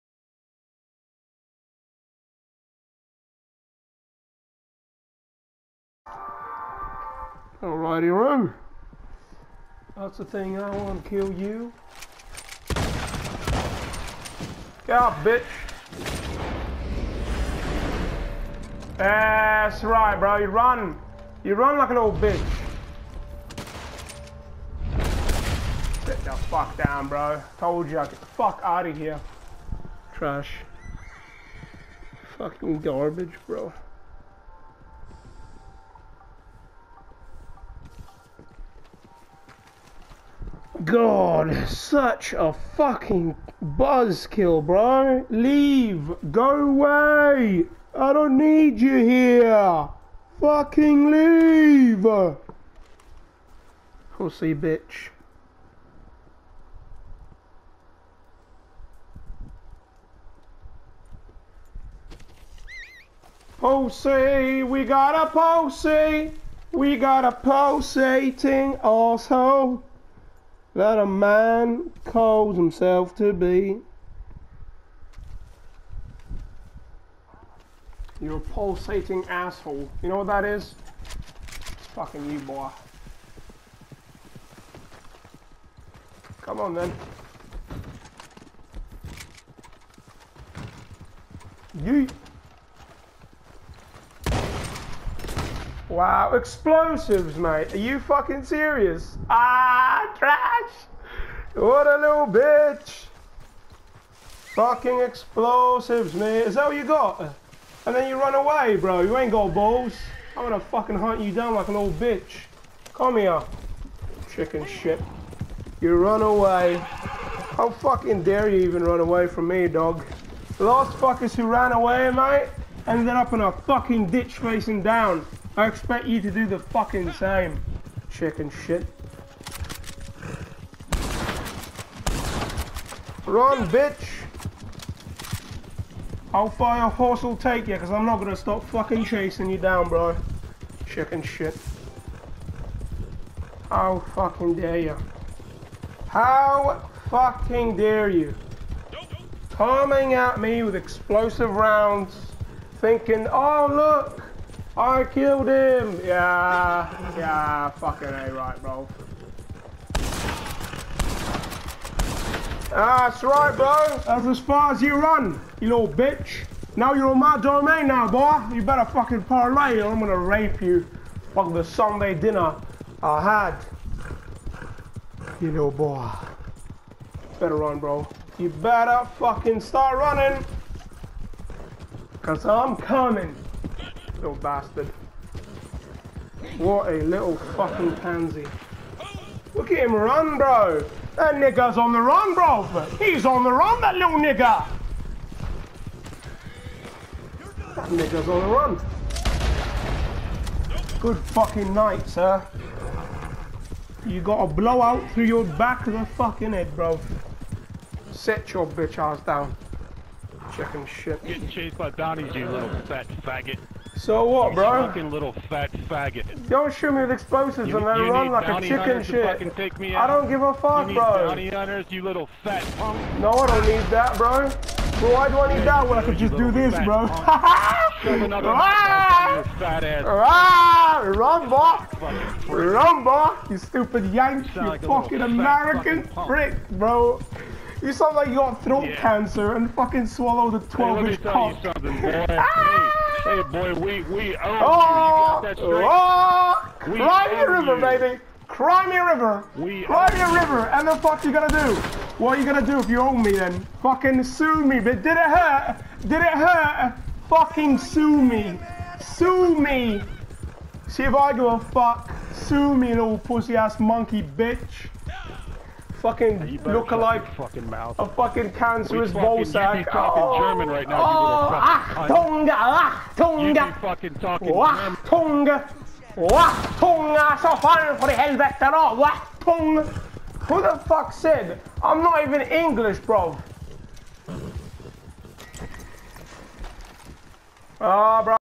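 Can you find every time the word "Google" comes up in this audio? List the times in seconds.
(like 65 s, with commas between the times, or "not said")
not said.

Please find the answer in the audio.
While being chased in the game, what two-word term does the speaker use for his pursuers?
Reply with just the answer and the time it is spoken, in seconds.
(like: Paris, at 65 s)
Bounty hunters, at 221 s.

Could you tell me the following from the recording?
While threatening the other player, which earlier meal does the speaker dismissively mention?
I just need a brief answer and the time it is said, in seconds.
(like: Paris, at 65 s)
Sunday dinner, at 171 s.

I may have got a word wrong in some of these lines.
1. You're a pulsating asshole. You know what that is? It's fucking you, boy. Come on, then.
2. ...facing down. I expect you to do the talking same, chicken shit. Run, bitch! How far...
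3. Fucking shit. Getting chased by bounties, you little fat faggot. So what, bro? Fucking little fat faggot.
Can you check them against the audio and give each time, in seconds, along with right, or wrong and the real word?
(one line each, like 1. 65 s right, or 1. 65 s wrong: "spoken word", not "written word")
1. 78 s right
2. 124 s wrong: "fucking", not "talking"
3. 210 s right.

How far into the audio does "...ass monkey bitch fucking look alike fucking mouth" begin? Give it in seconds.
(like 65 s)
263 s.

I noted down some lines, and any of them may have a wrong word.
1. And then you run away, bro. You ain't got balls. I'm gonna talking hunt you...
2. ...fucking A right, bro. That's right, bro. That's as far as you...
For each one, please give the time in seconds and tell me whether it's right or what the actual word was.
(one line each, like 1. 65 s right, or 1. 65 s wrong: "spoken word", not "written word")
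1. 107 s wrong: "fucking", not "talking"
2. 157 s right.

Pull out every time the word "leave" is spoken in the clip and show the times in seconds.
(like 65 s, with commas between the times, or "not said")
45 s, 51 s.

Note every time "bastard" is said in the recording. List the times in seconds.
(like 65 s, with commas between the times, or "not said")
184 s.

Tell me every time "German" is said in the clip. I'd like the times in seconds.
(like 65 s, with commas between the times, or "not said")
270 s, 274 s.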